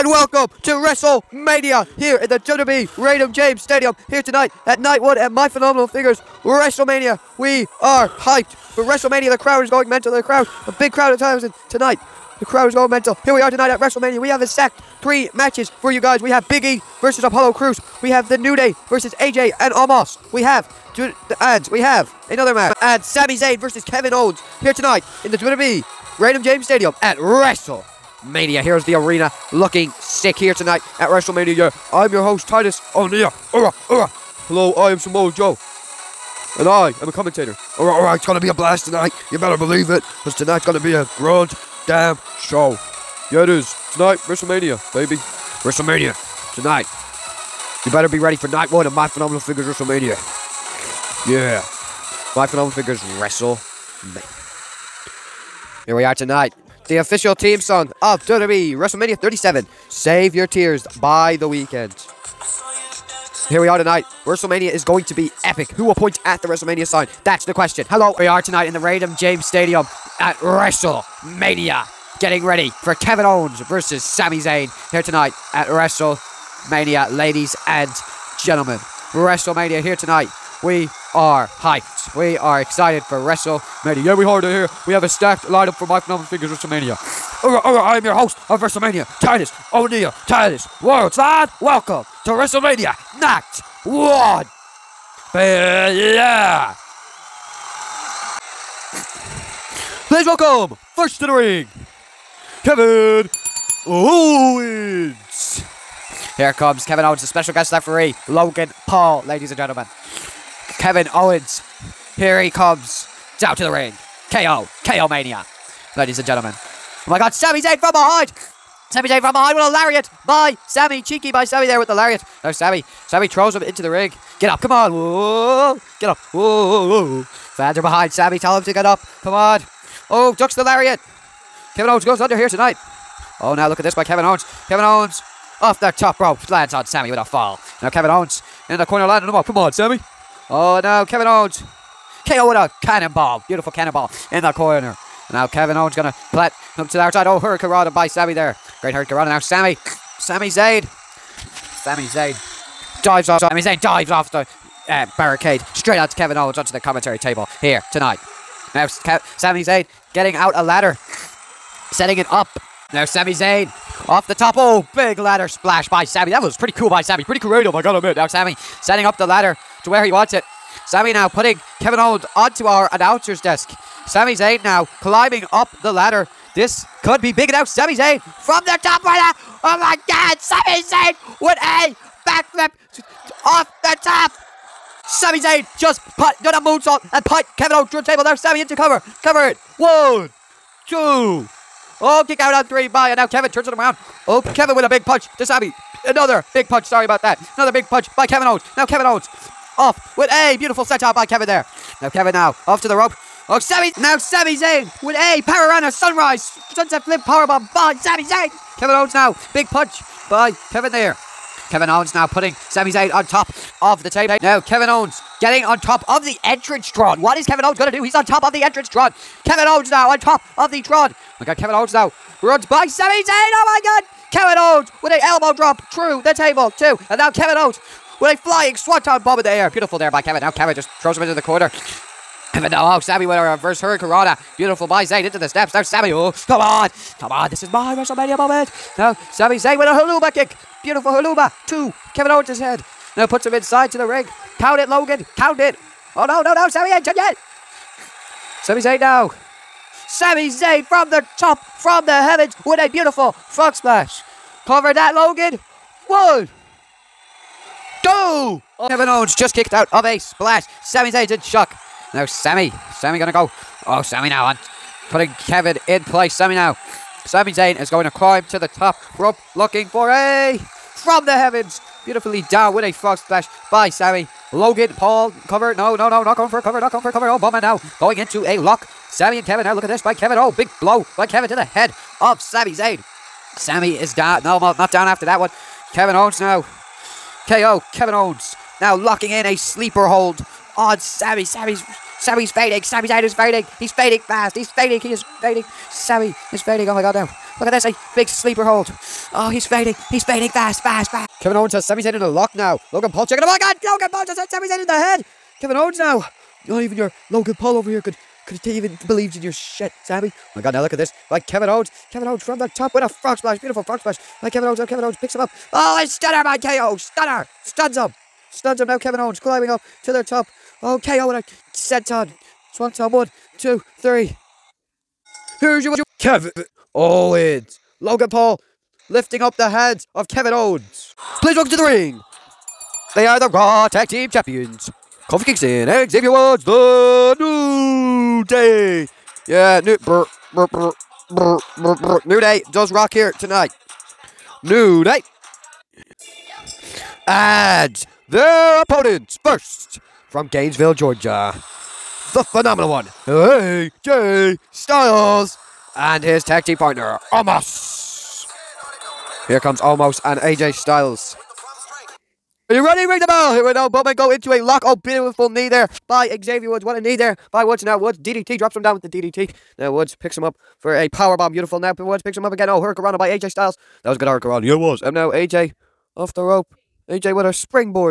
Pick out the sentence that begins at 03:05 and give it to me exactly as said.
Sami Zayn just put, did a moonsault and put Kevin Owens through the table.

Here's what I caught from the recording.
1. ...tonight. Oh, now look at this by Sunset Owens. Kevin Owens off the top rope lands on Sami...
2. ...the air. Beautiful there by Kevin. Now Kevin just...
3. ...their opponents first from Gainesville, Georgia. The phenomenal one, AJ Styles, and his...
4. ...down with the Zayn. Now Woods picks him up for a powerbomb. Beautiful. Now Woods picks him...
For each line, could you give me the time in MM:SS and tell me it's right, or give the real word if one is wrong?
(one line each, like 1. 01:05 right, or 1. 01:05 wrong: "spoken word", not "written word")
1. 02:12 wrong: "Kevin", not "Sunset"
2. 03:49 right
3. 05:48 right
4. 06:08 wrong: "DDT", not "Zayn".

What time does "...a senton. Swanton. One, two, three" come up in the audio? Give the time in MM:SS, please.
05:21.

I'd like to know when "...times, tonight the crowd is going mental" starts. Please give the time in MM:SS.
00:11.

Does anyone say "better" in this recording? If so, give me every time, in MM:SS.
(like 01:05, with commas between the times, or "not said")
00:39, 00:47.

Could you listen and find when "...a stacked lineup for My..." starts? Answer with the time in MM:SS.
01:25.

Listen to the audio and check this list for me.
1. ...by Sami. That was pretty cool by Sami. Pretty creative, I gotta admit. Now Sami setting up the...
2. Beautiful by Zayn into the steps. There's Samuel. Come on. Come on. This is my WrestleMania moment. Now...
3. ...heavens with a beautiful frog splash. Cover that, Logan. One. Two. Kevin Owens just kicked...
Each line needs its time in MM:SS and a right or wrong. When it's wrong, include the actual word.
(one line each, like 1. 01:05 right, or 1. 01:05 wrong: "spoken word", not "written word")
1. 02:45 right
2. 03:54 right
3. 04:12 right.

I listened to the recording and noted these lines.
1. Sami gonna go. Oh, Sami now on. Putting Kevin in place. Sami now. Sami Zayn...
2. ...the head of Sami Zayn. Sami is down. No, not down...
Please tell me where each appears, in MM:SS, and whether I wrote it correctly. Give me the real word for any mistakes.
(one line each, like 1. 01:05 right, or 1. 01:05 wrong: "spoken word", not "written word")
1. 04:22 right
2. 04:41 right.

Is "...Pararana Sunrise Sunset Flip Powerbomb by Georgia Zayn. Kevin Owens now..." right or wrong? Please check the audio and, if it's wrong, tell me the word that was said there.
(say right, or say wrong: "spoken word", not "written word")
wrong: "Sami", not "Georgia".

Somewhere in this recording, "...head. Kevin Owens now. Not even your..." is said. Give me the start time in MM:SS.
05:04.